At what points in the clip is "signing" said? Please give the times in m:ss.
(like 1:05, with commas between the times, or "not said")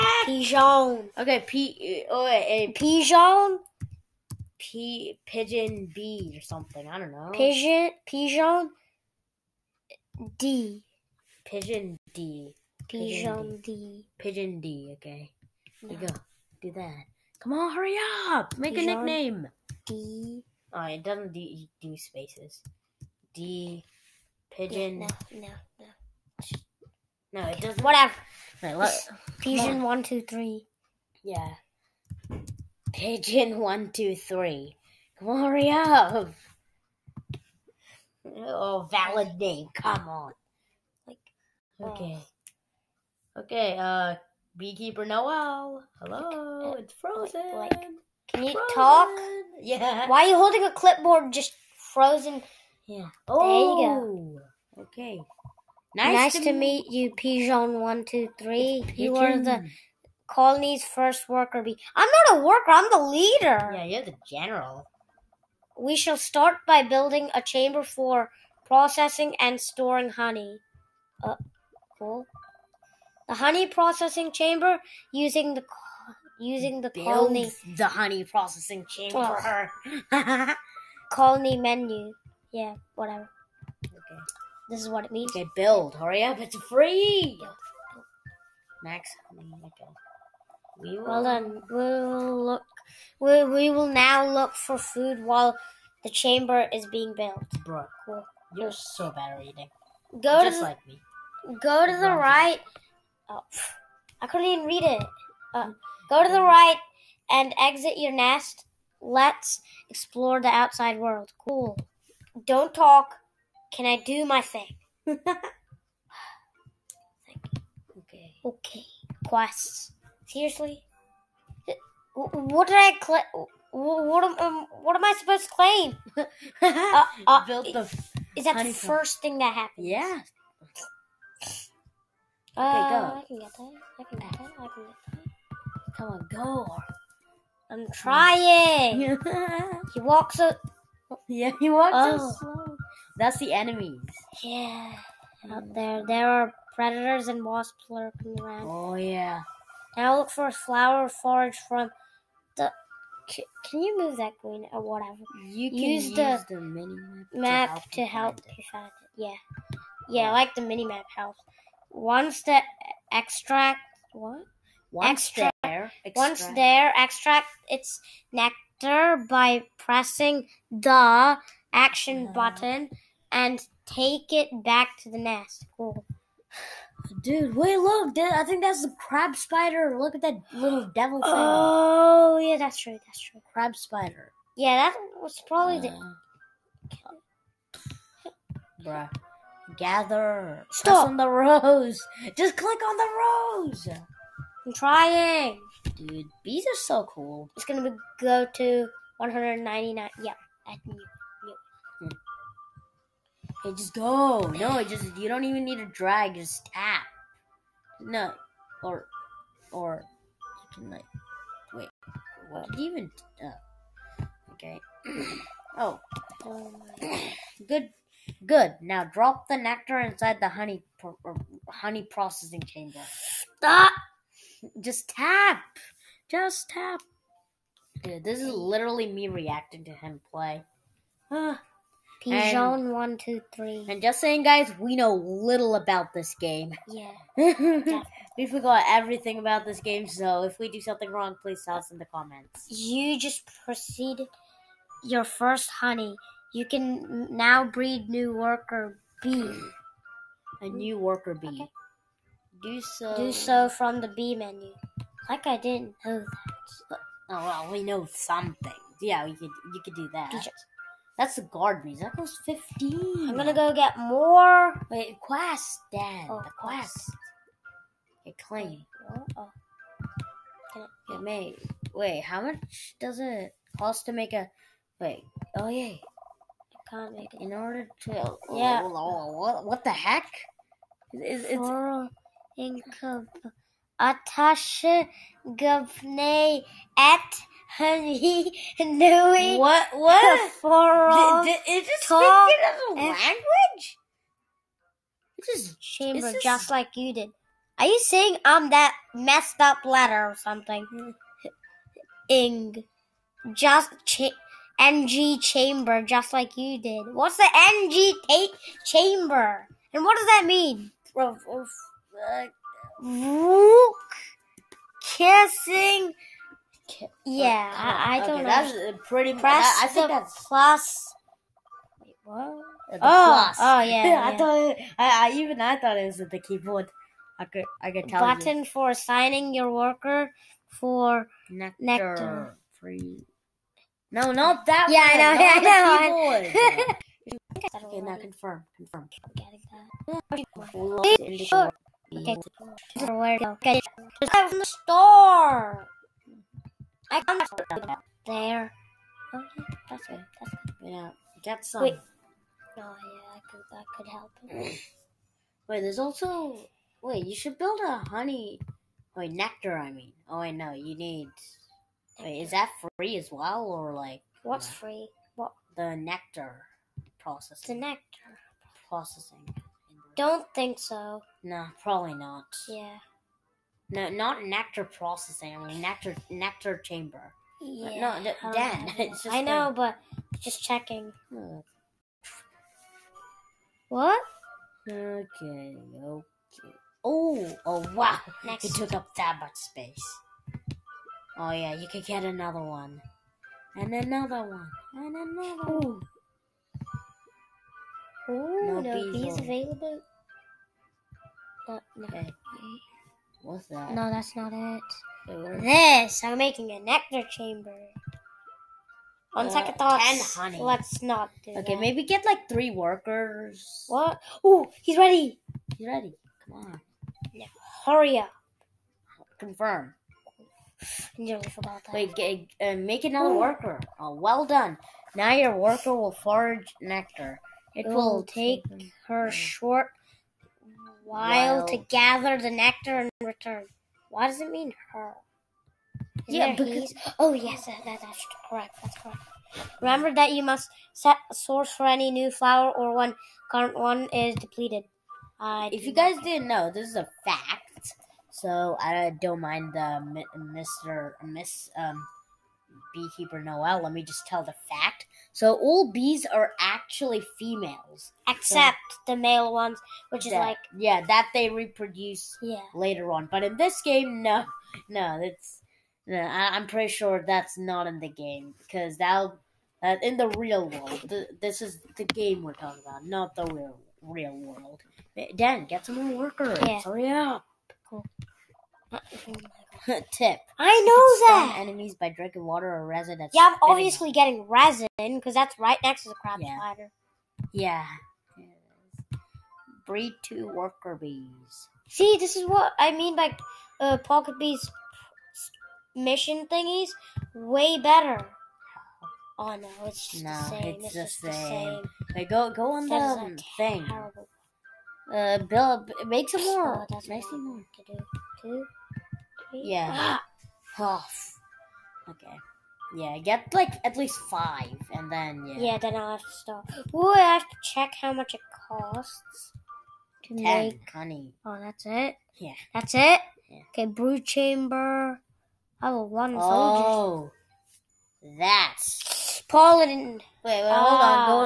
5:28.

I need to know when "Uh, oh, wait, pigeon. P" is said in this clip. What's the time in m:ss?
0:02.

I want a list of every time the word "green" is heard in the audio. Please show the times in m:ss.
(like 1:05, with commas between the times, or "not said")
2:34.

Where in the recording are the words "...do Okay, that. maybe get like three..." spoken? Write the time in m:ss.
6:51.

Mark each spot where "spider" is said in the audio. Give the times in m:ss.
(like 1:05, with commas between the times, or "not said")
2:59, 3:03, 8:06.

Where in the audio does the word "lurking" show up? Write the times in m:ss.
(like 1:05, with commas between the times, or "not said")
2:27.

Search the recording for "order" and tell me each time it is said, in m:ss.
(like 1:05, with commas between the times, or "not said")
4:37.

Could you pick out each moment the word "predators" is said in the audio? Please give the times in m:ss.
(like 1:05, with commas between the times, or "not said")
2:26.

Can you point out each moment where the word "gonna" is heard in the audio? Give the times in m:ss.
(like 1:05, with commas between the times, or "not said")
3:17, 4:23.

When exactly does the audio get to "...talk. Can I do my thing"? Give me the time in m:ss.
1:52.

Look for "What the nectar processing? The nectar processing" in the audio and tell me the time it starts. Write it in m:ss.
6:05.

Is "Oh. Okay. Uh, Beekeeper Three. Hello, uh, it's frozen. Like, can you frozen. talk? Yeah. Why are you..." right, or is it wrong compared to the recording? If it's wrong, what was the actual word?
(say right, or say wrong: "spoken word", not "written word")
wrong: "Noel", not "Three".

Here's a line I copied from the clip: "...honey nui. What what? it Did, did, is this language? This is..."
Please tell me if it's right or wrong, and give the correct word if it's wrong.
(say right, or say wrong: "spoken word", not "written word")
right.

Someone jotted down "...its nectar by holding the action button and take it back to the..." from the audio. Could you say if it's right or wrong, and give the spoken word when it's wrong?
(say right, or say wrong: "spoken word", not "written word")
wrong: "pressing", not "holding".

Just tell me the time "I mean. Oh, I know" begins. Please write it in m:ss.
5:59.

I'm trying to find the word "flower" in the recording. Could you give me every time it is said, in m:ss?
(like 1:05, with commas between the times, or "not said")
2:30, 7:22.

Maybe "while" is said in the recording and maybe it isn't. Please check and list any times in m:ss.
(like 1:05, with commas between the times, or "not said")
1:35, 7:11.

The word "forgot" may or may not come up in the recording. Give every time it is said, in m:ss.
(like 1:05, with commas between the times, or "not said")
3:58, 7:01.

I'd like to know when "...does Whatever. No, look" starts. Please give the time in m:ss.
0:27.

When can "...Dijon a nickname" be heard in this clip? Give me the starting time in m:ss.
0:18.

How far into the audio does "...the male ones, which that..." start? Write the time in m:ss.
7:39.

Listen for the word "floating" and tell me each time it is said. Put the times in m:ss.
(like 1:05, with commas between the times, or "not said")
not said.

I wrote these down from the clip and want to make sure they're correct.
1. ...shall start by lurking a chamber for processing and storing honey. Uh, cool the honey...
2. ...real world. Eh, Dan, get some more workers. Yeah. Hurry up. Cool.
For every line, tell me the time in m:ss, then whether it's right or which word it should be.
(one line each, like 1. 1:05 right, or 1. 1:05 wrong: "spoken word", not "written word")
1. 1:05 wrong: "building", not "lurking"
2. 7:54 right.